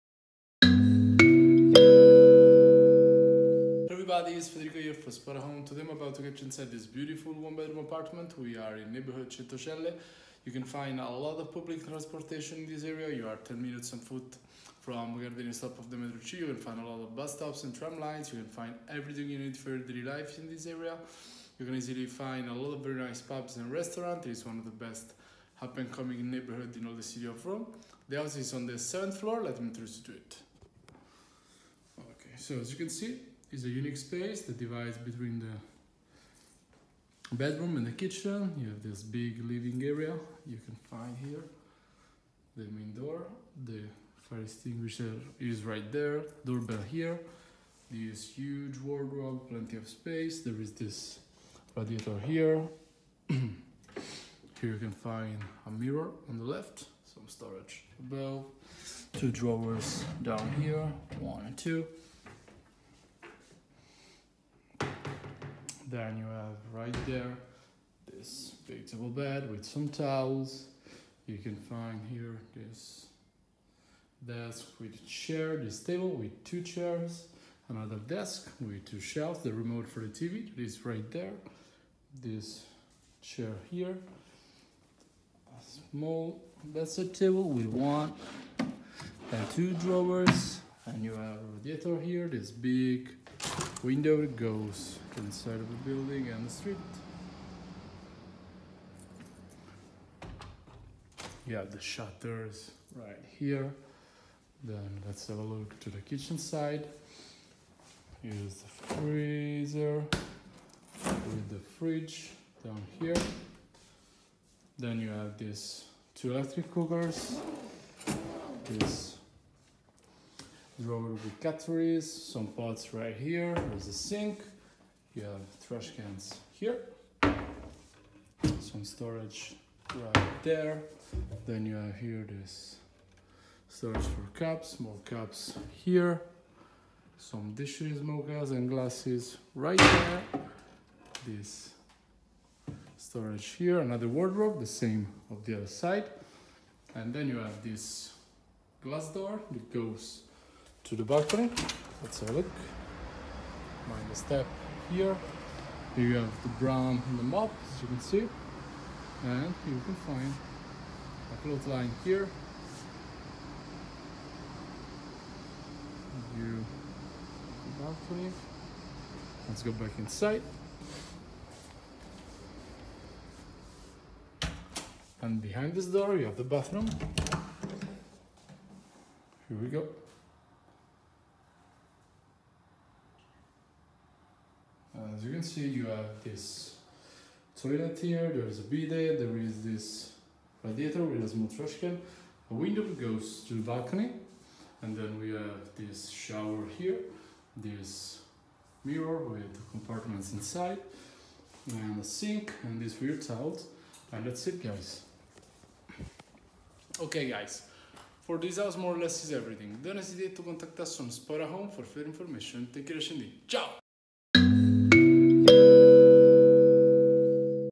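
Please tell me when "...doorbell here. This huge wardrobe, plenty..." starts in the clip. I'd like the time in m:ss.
0:46.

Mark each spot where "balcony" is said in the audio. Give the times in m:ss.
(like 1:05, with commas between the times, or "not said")
2:31, 2:47, 3:13.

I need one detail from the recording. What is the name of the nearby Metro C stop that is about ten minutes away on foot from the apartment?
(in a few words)
Gardenie.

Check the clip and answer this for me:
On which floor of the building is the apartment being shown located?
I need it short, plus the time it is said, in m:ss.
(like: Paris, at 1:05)
7th floor, at 0:28.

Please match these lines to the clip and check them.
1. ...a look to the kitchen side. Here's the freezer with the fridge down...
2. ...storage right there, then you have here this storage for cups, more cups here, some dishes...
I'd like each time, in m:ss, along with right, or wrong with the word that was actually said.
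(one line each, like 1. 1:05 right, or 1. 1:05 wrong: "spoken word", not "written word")
1. 1:45 right
2. 2:08 right.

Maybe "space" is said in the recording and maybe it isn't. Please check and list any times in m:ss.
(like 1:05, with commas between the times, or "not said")
0:33, 0:49.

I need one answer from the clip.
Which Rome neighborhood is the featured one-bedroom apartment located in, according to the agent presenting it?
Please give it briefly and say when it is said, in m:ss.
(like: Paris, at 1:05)
Centocelle, at 0:09.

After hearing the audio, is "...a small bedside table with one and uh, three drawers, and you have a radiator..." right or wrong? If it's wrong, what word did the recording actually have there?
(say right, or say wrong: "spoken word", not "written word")
wrong: "two", not "three".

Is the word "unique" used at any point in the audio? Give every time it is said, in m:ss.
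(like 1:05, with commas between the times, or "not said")
0:33.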